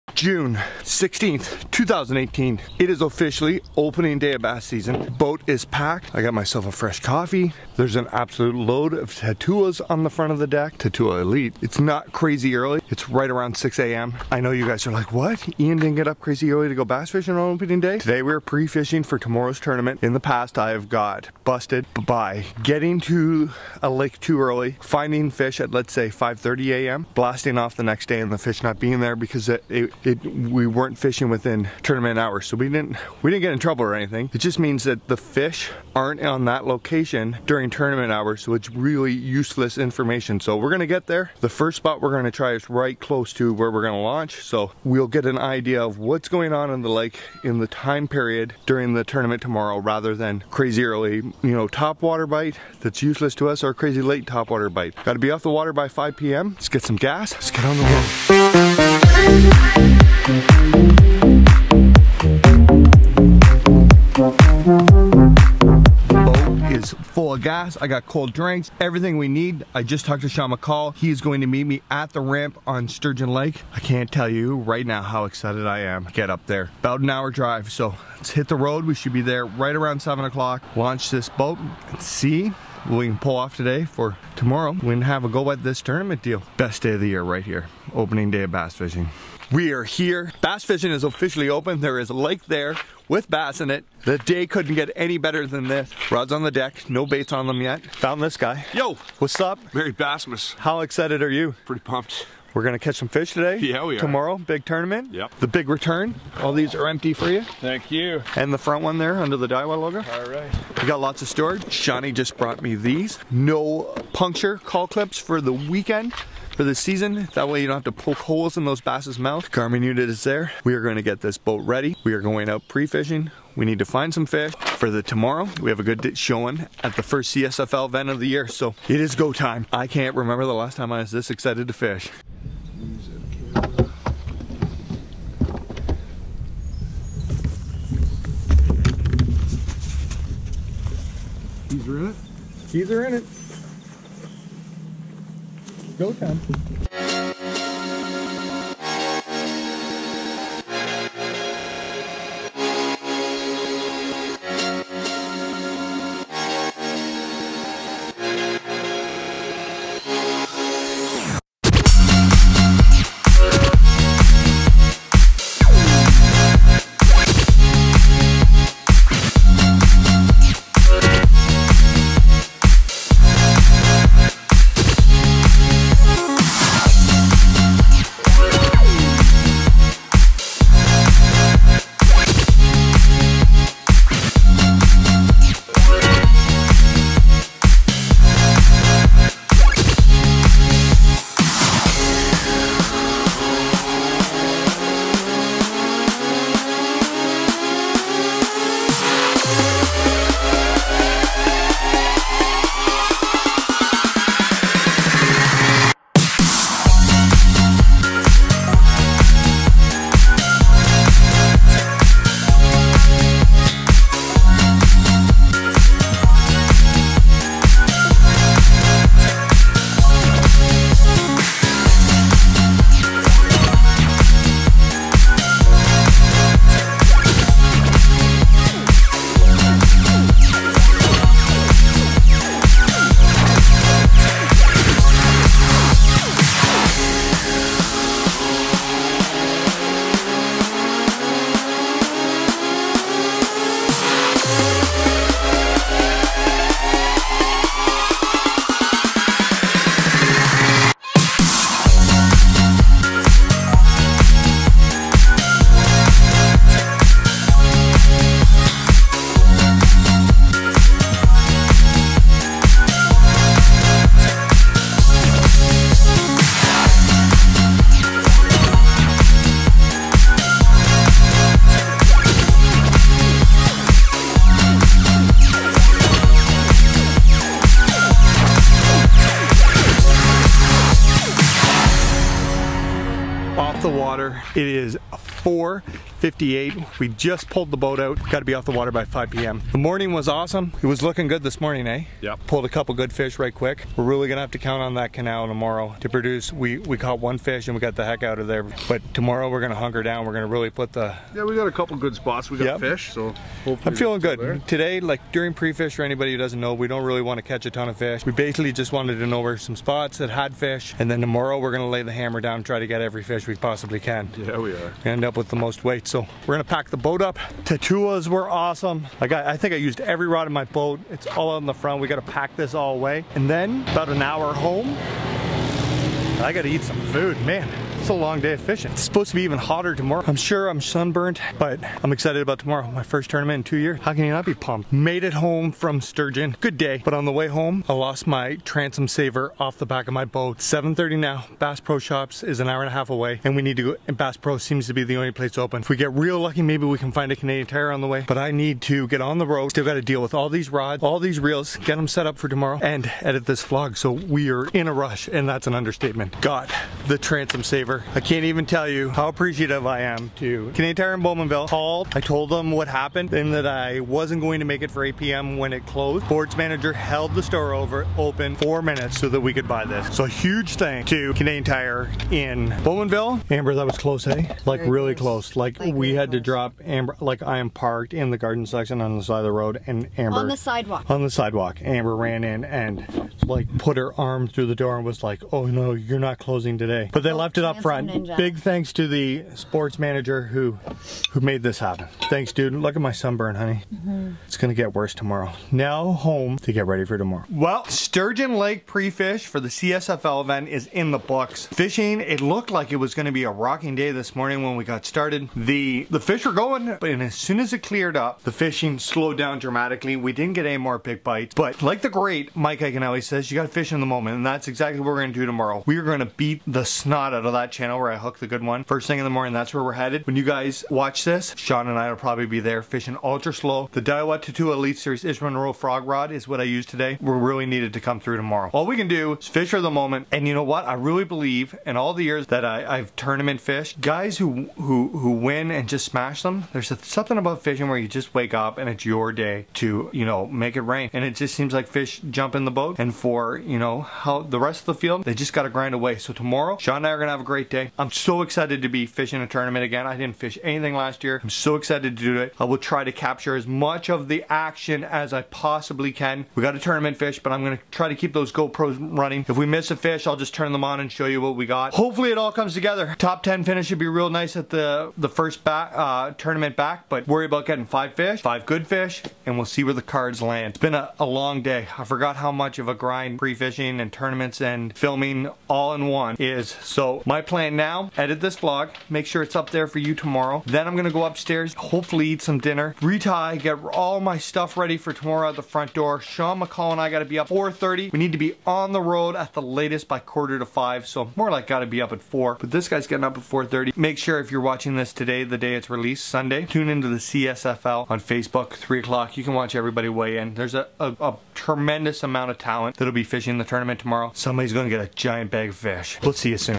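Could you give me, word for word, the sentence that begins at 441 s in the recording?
And it just seems like fish jump in the boat.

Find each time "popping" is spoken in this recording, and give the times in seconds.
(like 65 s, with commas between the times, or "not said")
not said.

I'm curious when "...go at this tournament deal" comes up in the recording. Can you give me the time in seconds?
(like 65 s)
85 s.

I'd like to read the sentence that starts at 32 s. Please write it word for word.
So we didn't we didn't get in trouble or anything.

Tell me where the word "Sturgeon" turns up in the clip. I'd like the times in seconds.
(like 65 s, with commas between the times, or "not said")
72 s, 336 s, 397 s.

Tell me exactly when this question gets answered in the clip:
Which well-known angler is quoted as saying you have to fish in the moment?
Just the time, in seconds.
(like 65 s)
412 s.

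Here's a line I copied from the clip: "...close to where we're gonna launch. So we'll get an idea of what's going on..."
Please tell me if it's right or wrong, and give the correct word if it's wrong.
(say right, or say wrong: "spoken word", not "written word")
right.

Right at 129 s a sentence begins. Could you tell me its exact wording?
I can't remember the last time I was this excited to fish.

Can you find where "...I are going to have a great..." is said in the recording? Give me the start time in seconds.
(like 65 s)
447 s.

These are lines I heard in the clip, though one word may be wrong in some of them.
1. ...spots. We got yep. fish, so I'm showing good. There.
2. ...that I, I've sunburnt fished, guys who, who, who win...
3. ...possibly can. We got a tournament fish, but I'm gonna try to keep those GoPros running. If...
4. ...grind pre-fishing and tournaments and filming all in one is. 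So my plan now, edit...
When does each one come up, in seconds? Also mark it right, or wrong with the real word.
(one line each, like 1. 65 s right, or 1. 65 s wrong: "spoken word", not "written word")
1. 302 s wrong: "feeling", not "showing"
2. 432 s wrong: "tournament", not "sunburnt"
3. 455 s right
4. 472 s right.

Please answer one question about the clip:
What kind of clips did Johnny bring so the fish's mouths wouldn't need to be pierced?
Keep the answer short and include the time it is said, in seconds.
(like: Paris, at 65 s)
No puncture cull clips, at 113 s.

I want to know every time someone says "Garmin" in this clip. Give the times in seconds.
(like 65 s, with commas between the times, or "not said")
119 s.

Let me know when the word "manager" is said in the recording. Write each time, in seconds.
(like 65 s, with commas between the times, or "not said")
366 s, 389 s.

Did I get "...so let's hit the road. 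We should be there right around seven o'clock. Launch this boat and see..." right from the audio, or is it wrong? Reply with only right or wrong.
right.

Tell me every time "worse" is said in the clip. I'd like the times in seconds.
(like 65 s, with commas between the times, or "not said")
394 s.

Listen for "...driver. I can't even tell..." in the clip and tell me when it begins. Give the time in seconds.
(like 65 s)
357 s.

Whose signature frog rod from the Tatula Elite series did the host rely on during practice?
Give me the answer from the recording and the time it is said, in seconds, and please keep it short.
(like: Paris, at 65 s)
Ish Monroe, at 425 s.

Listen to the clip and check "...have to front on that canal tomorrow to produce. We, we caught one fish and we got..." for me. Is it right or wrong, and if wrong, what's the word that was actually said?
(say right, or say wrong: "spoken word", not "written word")
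wrong: "count", not "front".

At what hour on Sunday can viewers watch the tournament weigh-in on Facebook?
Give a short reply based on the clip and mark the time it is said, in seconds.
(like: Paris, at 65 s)
3 o'clock, at 498 s.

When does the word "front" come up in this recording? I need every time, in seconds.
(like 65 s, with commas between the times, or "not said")
10 s, 108 s, 321 s, 387 s, 485 s.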